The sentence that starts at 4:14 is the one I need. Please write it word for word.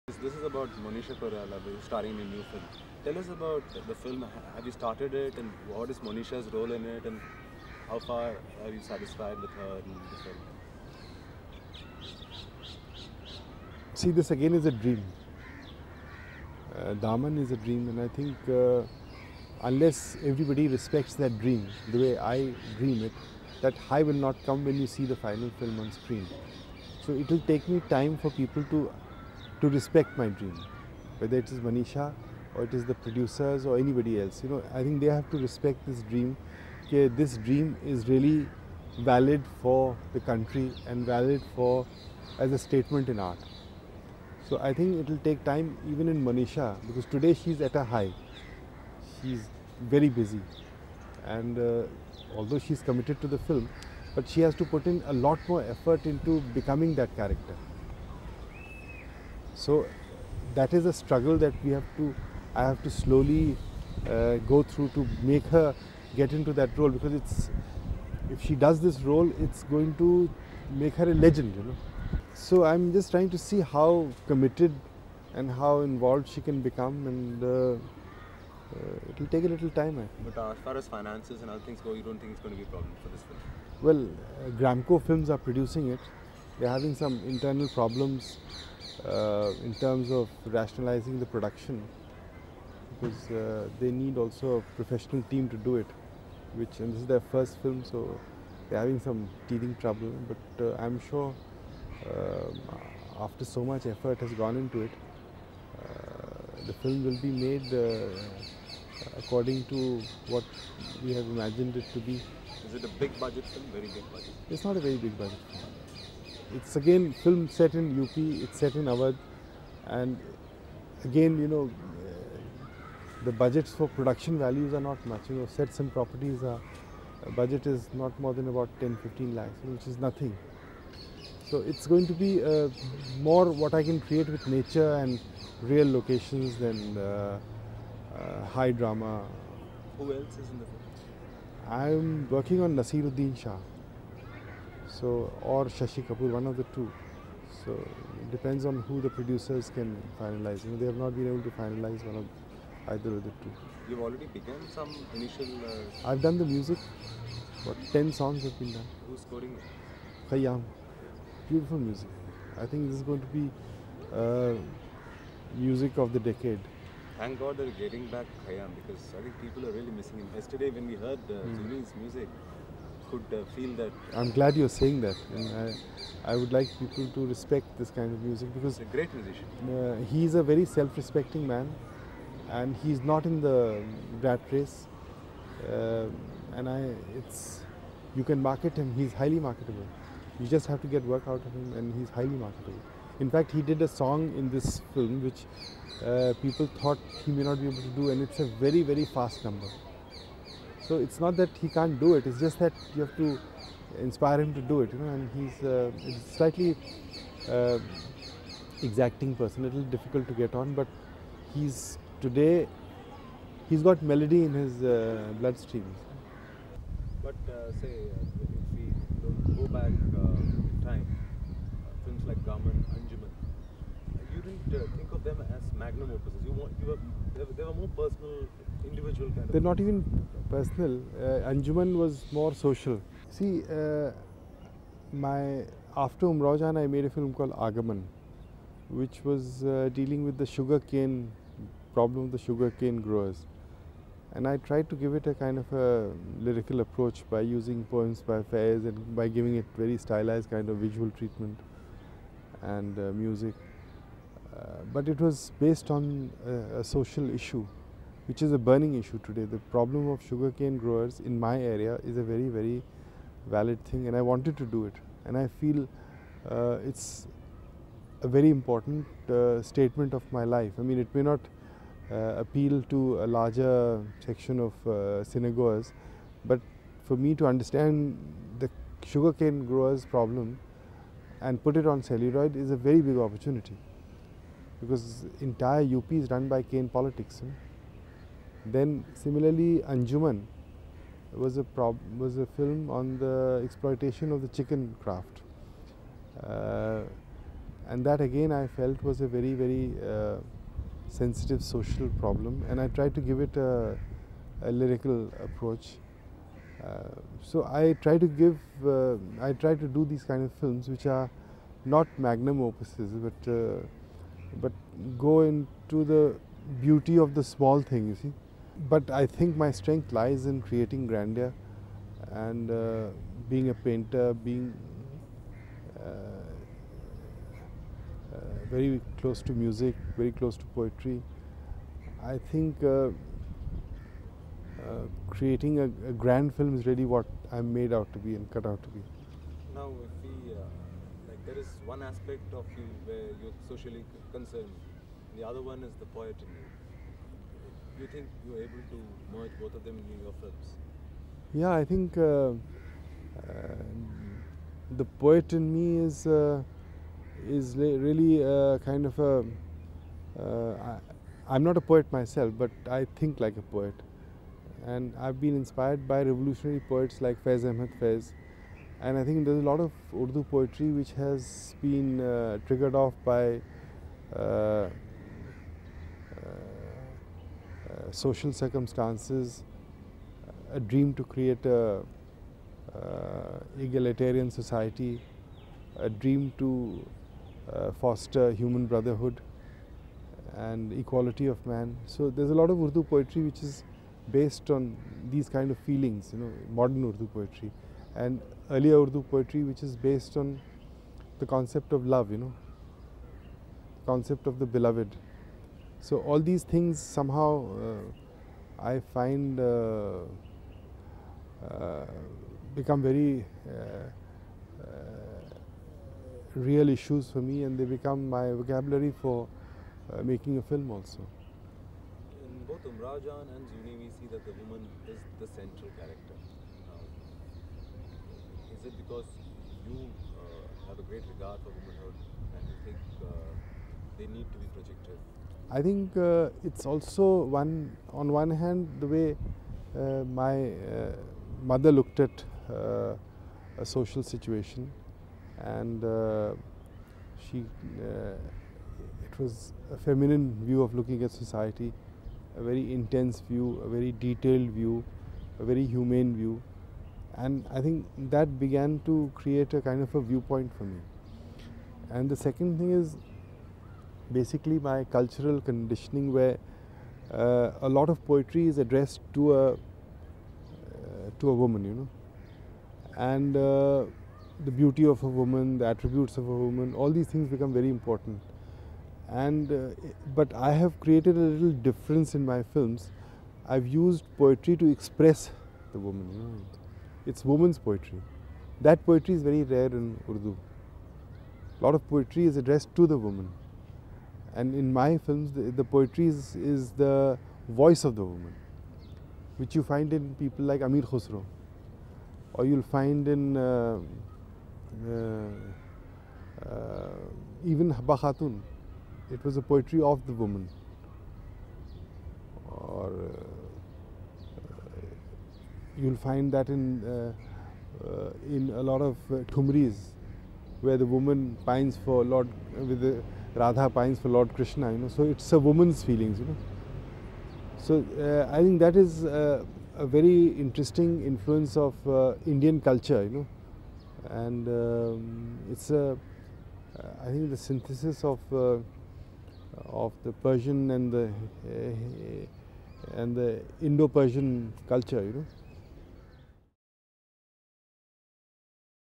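Uh, but it was based on uh, a social issue which is a burning issue today.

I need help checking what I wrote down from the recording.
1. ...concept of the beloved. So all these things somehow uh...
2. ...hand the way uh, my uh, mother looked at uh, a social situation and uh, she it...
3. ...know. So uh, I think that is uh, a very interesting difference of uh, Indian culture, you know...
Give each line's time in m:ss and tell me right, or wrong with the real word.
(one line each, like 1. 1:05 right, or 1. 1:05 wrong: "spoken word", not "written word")
1. 6:44 right
2. 7:18 right
3. 8:46 wrong: "influence", not "difference".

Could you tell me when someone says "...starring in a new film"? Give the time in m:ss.
0:01.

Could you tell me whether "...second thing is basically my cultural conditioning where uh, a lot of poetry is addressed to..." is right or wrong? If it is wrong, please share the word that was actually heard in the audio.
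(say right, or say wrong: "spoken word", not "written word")
right.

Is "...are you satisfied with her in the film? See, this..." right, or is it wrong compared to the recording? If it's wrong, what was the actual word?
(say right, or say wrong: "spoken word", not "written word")
right.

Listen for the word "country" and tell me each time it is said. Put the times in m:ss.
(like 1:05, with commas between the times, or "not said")
0:40.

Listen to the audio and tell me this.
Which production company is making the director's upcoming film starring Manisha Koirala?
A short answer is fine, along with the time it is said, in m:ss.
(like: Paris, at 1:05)
Gramco Films, at 1:24.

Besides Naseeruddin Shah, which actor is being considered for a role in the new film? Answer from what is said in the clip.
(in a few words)
Shashi Kapoor.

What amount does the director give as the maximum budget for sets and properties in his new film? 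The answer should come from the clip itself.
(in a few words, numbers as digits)
10-15 lakhs.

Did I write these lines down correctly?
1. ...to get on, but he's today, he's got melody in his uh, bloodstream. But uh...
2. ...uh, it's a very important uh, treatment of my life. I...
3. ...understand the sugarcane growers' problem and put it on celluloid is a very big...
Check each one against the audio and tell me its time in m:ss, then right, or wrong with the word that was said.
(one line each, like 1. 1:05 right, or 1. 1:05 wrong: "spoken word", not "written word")
1. 3:30 right
2. 4:26 wrong: "statement", not "treatment"
3. 4:37 right.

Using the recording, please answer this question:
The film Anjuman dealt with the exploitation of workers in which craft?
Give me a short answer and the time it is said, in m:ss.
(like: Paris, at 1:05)
chicken craft, at 4:54.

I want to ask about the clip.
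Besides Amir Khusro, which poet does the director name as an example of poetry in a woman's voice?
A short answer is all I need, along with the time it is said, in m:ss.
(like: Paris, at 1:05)
Habba Khatun, at 8:27.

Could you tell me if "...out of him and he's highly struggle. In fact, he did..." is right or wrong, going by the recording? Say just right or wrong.
wrong.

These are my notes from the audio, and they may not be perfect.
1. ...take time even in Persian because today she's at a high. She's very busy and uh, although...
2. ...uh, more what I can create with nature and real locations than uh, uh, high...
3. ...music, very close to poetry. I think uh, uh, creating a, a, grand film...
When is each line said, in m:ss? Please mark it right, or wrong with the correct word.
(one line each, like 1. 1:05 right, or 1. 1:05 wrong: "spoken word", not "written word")
1. 0:45 wrong: "Manisha", not "Persian"
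2. 2:12 right
3. 5:29 right.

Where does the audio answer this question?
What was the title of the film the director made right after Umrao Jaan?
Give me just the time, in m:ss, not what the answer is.
3:57.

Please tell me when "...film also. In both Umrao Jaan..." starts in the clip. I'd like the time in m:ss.
7:00.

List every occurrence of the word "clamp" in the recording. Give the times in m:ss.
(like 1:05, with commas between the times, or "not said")
not said.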